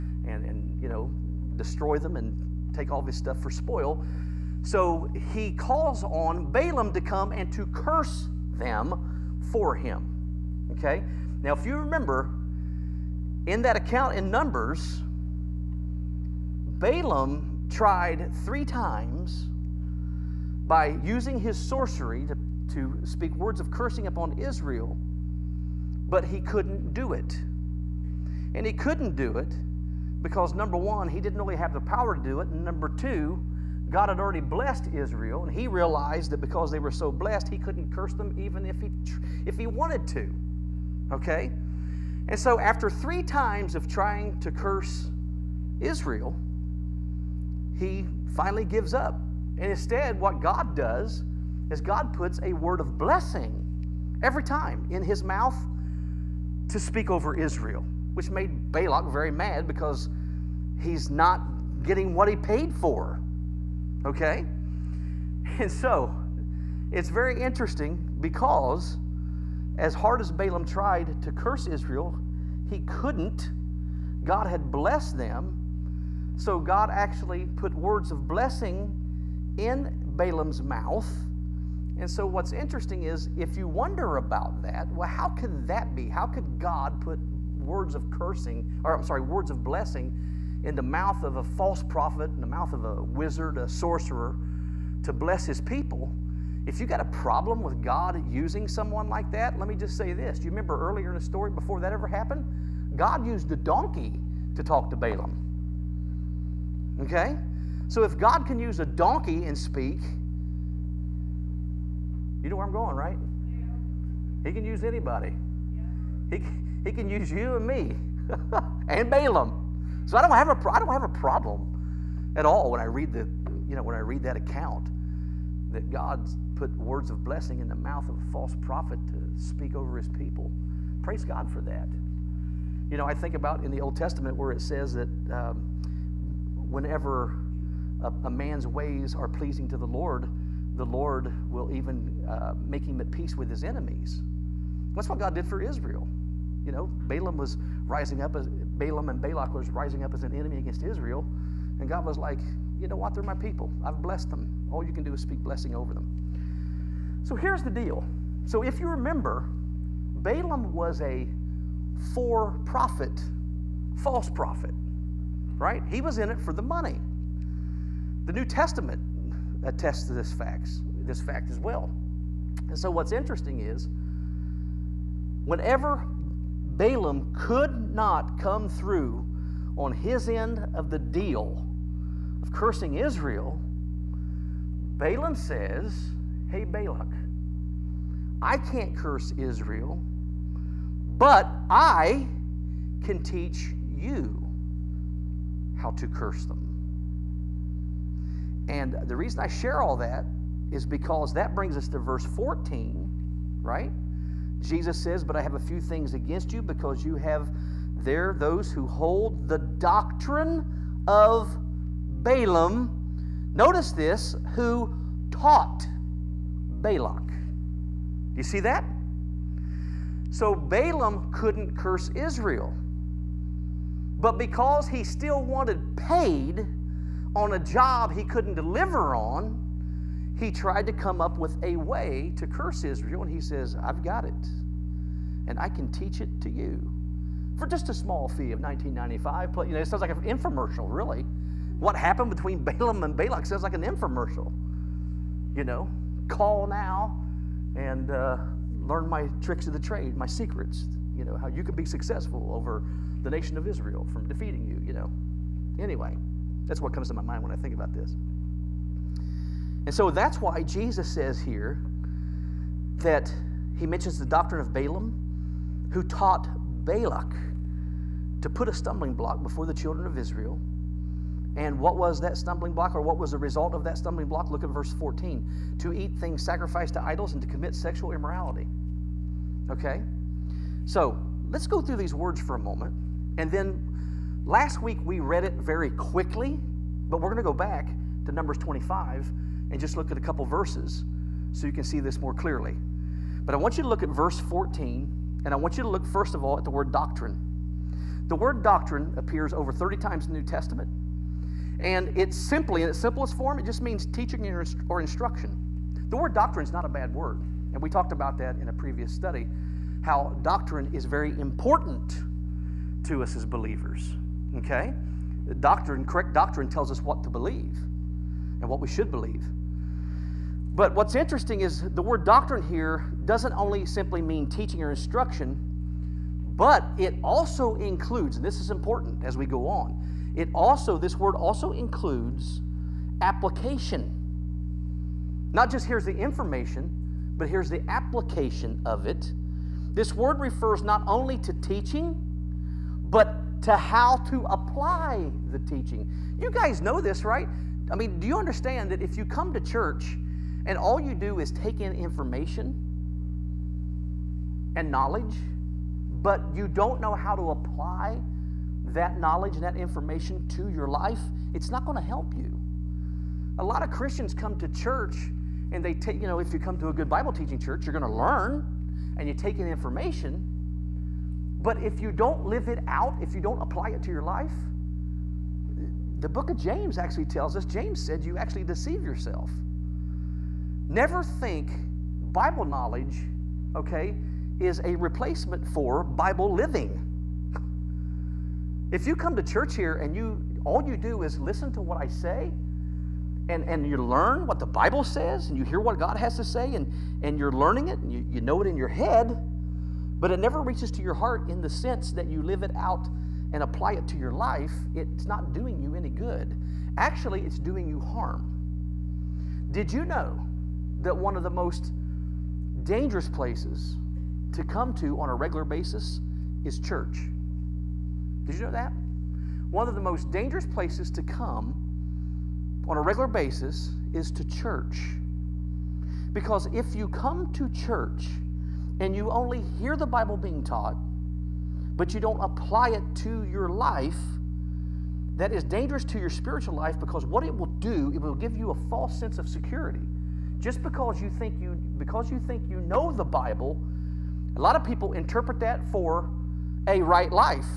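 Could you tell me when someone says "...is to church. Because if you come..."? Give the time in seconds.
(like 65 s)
424 s.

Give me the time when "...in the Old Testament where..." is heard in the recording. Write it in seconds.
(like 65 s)
133 s.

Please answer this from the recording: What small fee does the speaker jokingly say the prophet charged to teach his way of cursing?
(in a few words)
1995.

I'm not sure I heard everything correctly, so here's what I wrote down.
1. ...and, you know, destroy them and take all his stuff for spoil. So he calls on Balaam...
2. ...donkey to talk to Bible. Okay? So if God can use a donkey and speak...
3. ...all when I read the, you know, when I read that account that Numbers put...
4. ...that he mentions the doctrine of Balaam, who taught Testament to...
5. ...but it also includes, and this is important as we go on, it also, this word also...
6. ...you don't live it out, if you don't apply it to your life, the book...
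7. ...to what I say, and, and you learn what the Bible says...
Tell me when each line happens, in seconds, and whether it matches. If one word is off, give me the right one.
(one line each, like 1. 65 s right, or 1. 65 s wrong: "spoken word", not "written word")
1. 0 s right
2. 103 s wrong: "Balaam", not "Bible"
3. 122 s wrong: "God", not "Numbers"
4. 262 s wrong: "Balak", not "Testament"
5. 326 s right
6. 372 s right
7. 391 s right.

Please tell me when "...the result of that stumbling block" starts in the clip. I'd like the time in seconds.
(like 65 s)
273 s.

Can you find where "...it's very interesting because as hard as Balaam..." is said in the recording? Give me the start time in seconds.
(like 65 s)
66 s.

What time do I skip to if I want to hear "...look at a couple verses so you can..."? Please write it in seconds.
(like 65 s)
289 s.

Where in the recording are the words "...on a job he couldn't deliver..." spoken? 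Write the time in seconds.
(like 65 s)
227 s.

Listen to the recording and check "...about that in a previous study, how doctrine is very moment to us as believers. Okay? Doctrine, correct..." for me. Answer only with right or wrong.
wrong.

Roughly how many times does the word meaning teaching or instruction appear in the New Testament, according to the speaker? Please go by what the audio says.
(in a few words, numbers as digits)
Over 30.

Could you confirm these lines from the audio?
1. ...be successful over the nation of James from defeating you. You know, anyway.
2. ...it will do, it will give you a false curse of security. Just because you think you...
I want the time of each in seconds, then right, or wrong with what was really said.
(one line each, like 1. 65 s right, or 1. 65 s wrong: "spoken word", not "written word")
1. 251 s wrong: "Israel", not "James"
2. 437 s wrong: "sense", not "curse".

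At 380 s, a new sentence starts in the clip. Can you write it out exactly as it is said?
Never think Bible knowledge, okay, is a replacement for Bible living.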